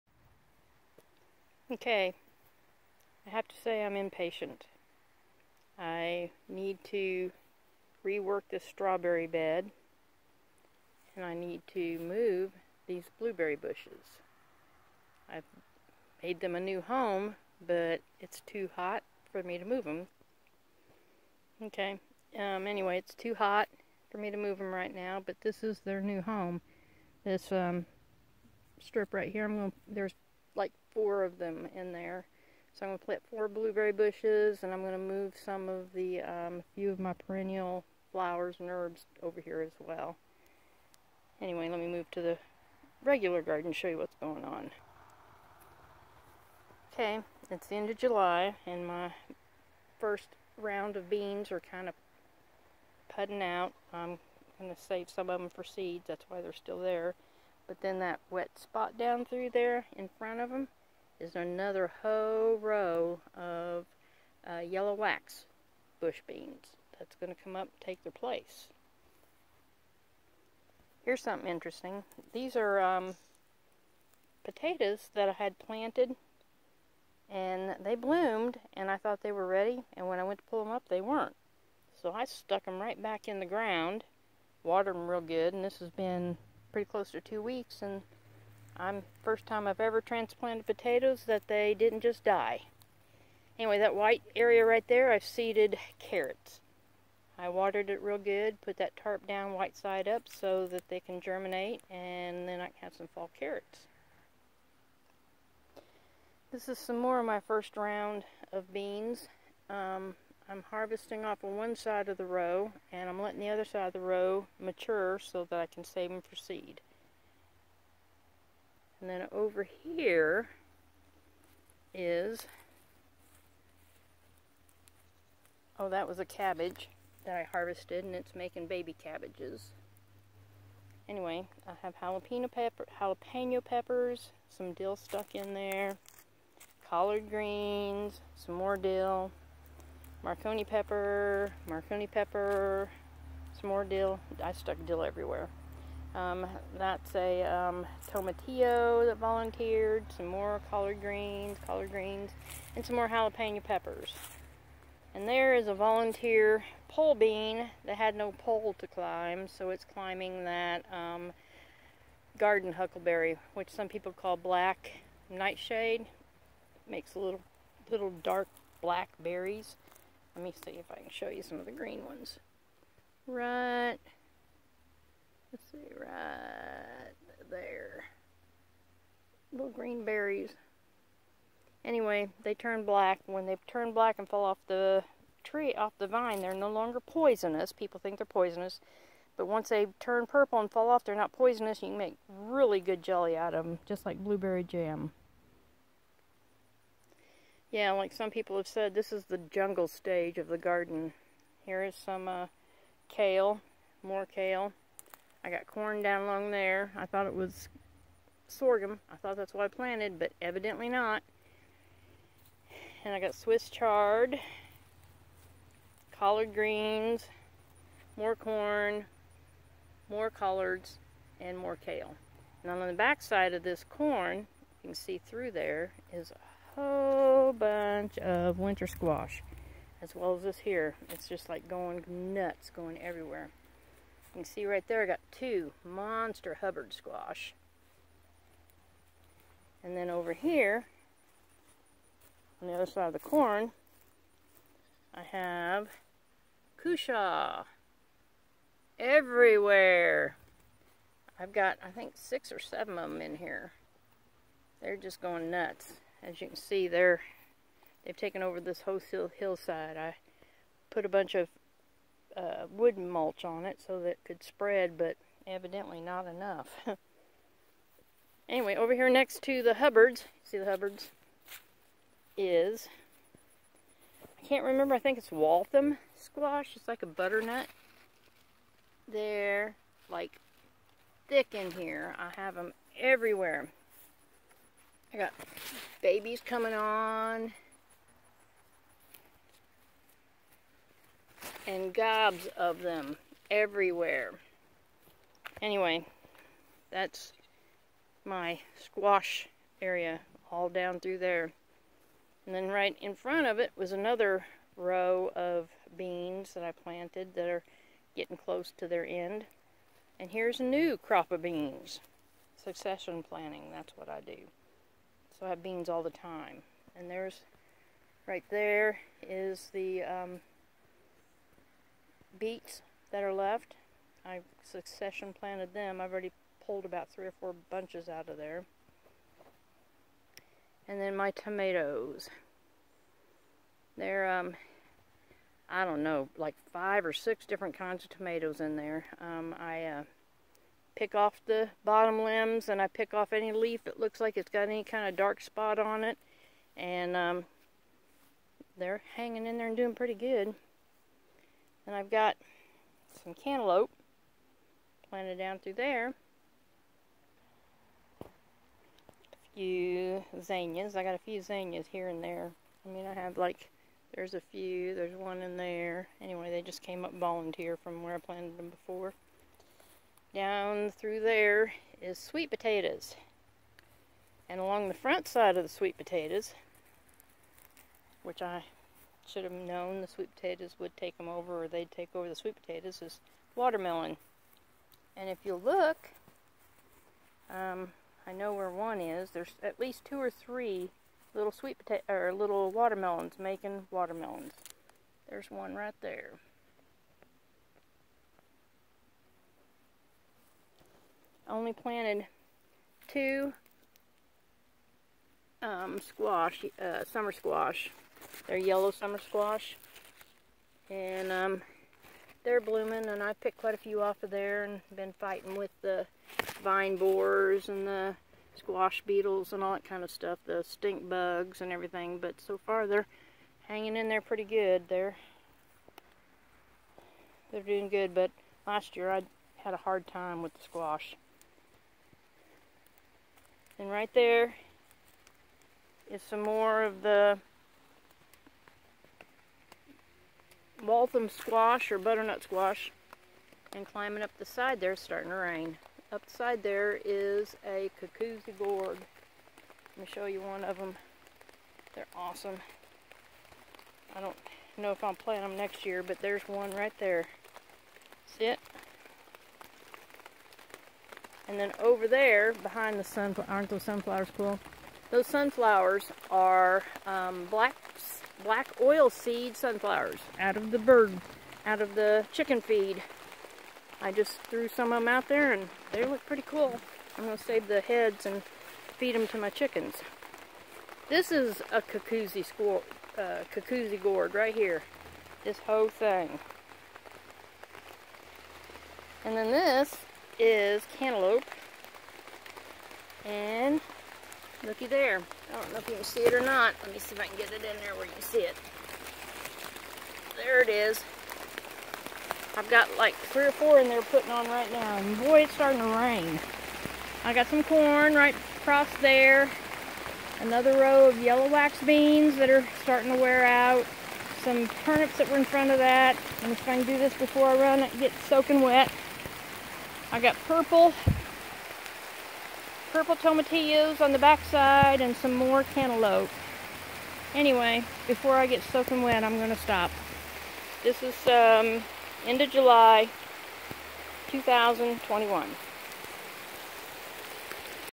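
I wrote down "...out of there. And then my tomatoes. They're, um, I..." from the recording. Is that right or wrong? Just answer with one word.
right.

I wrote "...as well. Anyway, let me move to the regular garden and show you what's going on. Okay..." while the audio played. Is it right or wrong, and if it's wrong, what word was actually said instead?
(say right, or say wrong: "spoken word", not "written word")
right.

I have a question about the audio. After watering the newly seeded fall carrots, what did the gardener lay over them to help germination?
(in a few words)
tarp.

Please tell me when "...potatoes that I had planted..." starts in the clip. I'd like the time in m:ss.
1:14.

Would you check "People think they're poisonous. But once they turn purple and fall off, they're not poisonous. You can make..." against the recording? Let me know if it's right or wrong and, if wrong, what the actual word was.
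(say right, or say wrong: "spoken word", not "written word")
right.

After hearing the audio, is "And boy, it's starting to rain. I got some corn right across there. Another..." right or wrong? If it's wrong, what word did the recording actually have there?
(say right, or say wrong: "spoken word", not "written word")
right.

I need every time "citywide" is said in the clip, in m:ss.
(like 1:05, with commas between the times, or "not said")
not said.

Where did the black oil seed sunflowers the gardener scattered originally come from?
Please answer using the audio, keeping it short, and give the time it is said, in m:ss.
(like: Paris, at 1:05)
chicken feed, at 7:52.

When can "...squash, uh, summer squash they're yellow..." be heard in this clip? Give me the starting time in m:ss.
6:46.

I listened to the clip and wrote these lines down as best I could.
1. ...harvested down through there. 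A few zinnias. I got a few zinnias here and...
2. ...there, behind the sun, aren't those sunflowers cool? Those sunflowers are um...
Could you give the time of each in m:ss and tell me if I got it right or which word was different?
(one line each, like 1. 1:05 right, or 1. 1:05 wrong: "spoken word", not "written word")
1. 5:55 wrong: "planted", not "harvested"
2. 7:42 right.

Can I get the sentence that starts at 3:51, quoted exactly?
It's just like going nuts, going everywhere.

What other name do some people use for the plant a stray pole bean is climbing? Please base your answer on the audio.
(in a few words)
black nightshade.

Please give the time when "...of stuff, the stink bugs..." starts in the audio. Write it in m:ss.
7:00.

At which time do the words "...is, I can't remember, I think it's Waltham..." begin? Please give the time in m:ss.
4:32.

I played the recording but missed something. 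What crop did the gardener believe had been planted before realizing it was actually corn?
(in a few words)
sorghum.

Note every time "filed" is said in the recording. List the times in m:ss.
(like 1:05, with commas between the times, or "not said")
not said.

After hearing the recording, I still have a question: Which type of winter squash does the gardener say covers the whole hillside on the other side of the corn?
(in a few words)
cushaw.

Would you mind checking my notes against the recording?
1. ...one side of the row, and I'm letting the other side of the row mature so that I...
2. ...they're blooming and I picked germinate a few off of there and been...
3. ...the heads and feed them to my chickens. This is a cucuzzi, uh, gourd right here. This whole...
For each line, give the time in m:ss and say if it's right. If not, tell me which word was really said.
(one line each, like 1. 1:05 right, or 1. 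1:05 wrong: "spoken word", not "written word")
1. 1:51 right
2. 6:52 wrong: "quite", not "germinate"
3. 7:57 right.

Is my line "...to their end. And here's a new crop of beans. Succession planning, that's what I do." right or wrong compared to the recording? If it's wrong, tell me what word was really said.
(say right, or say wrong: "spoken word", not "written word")
right.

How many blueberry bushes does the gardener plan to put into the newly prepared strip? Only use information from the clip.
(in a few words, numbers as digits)
4.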